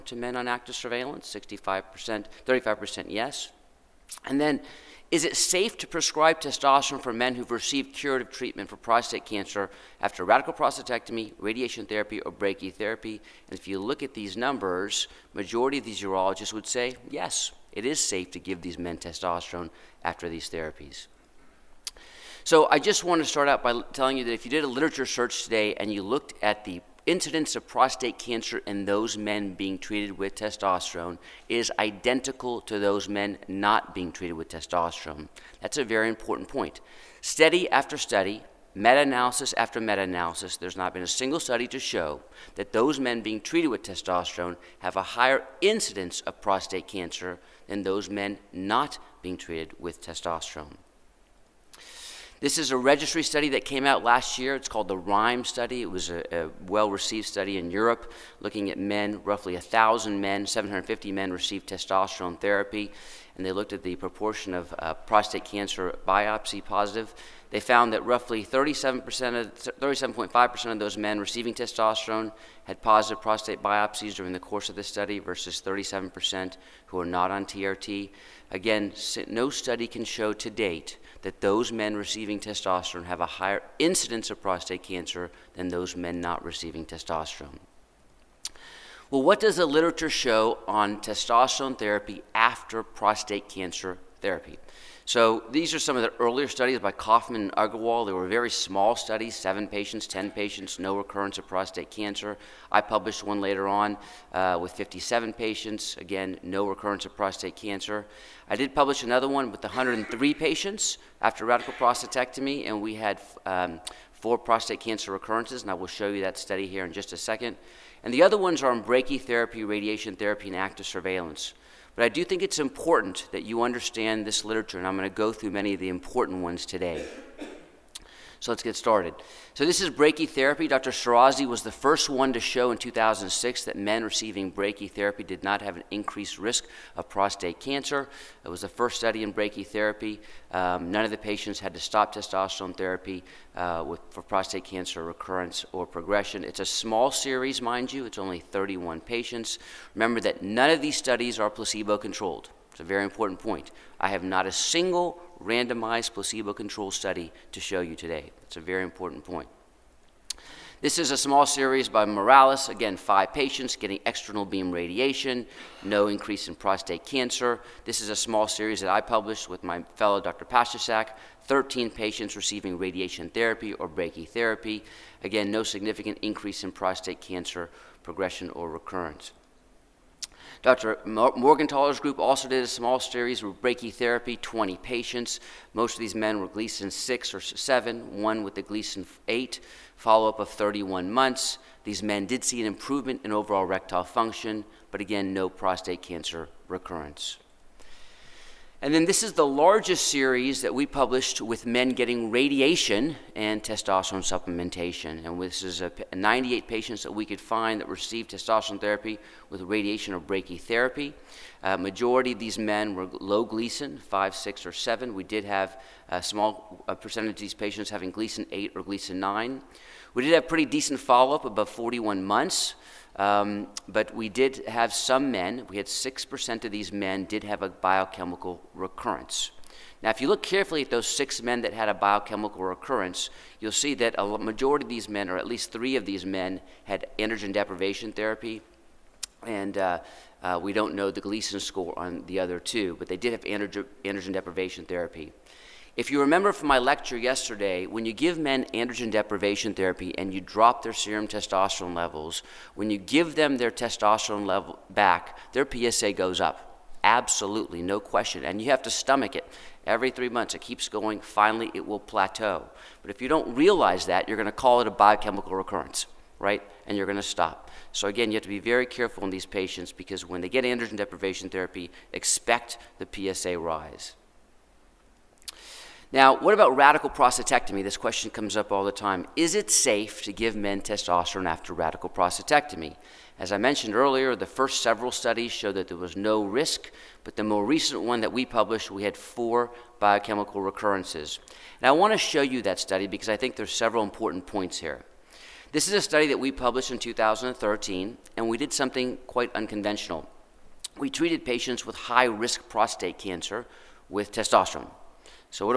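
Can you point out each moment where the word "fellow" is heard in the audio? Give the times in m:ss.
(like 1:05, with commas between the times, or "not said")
2:49.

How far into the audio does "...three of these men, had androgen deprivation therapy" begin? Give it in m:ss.
3:55.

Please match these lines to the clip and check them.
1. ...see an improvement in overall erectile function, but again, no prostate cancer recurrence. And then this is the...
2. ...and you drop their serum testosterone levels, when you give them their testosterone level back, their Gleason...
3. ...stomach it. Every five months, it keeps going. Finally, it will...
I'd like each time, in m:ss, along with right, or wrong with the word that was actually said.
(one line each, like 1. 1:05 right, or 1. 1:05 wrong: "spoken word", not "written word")
1. 3:12 right
2. 4:10 wrong: "PSA", not "Gleason"
3. 4:18 wrong: "three", not "five".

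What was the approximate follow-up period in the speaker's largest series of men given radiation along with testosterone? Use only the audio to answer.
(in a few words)
41 months.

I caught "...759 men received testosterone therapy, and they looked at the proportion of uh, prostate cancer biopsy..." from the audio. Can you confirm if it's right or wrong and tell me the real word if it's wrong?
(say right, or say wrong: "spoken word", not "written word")
wrong: "750", not "759".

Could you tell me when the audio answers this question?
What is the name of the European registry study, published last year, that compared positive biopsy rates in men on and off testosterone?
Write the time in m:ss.
0:54.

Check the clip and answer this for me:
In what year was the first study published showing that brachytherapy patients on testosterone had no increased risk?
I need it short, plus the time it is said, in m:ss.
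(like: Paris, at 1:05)
2006, at 2:12.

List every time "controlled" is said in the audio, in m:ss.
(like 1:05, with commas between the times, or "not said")
2:31, 2:36.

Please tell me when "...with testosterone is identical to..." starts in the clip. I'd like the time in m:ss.
0:30.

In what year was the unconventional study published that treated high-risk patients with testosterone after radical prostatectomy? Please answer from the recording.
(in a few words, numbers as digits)
2013.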